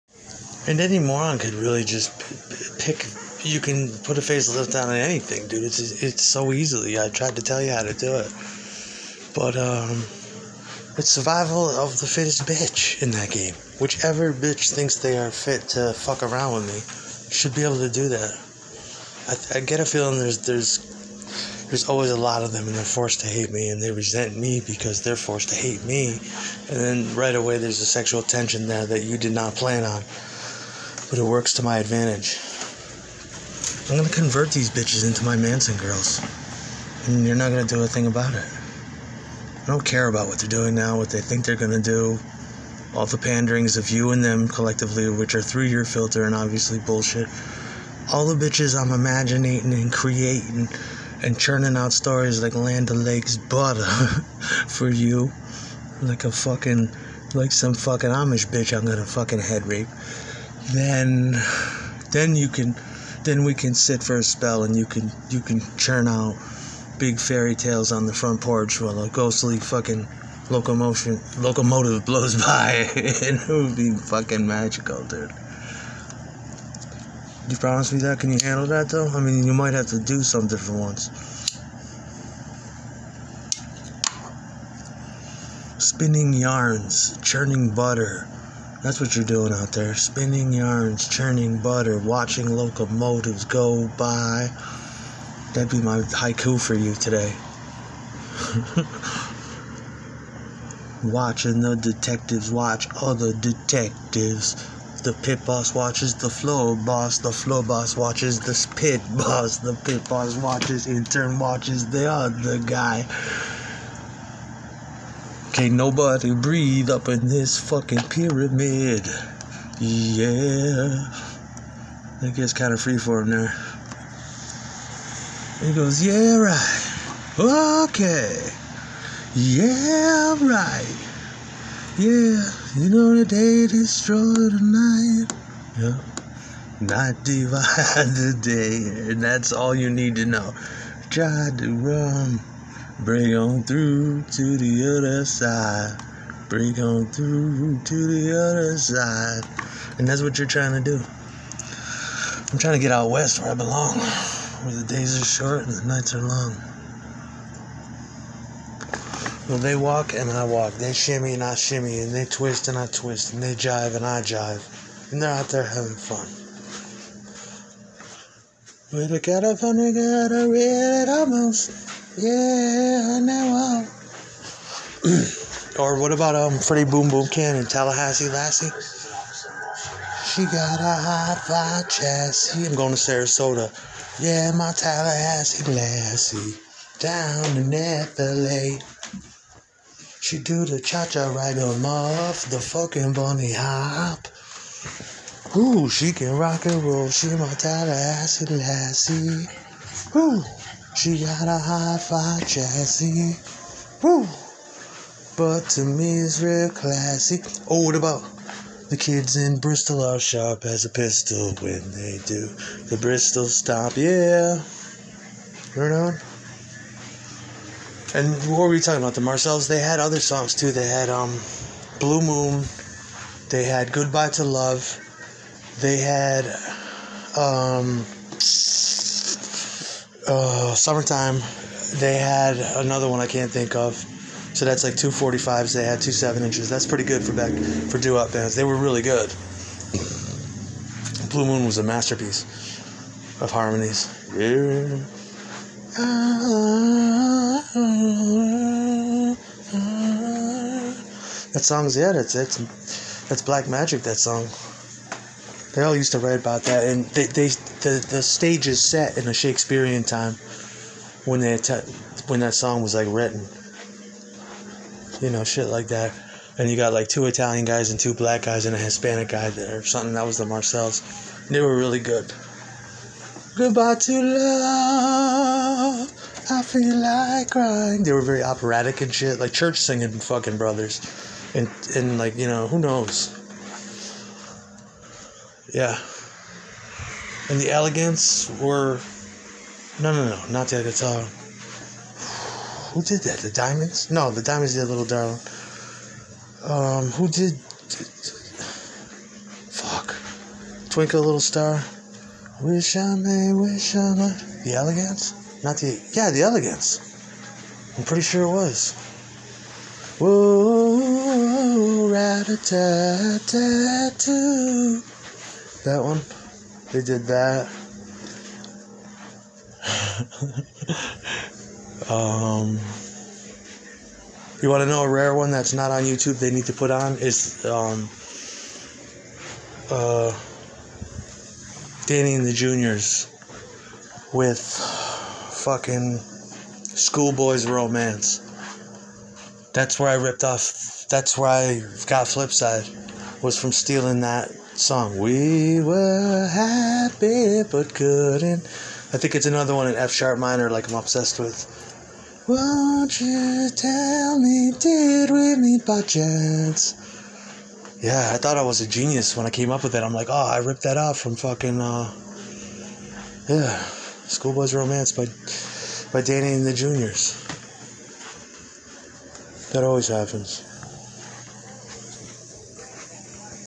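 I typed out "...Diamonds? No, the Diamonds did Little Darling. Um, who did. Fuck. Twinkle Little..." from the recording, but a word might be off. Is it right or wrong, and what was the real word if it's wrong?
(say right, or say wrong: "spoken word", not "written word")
right.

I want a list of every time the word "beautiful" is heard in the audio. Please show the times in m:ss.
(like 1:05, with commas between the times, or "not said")
not said.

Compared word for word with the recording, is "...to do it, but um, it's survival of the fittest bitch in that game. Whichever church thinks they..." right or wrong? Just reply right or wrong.
wrong.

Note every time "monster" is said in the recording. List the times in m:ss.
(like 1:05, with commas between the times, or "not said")
not said.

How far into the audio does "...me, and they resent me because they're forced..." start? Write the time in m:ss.
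0:23.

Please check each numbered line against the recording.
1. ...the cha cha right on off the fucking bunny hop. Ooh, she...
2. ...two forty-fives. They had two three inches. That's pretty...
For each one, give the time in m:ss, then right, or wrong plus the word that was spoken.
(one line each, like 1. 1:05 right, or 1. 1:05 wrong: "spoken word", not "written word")
1. 3:10 right
2. 3:54 wrong: "seven", not "three".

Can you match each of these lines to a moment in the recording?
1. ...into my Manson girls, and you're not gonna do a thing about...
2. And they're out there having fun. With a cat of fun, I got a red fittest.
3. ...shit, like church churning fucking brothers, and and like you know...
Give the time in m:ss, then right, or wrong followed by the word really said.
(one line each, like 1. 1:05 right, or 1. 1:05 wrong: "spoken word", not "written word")
1. 0:35 right
2. 2:45 wrong: "almost", not "fittest"
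3. 4:39 wrong: "singing", not "churning".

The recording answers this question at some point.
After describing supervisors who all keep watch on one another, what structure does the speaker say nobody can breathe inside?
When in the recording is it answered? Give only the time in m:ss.
1:58.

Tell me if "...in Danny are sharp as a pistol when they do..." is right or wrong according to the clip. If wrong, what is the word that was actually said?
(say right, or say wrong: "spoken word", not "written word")
wrong: "Bristol", not "Danny".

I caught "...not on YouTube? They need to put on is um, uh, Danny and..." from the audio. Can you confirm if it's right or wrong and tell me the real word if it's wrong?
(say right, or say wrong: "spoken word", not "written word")
right.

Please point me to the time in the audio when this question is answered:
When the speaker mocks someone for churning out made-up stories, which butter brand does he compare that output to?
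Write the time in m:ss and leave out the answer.
0:52.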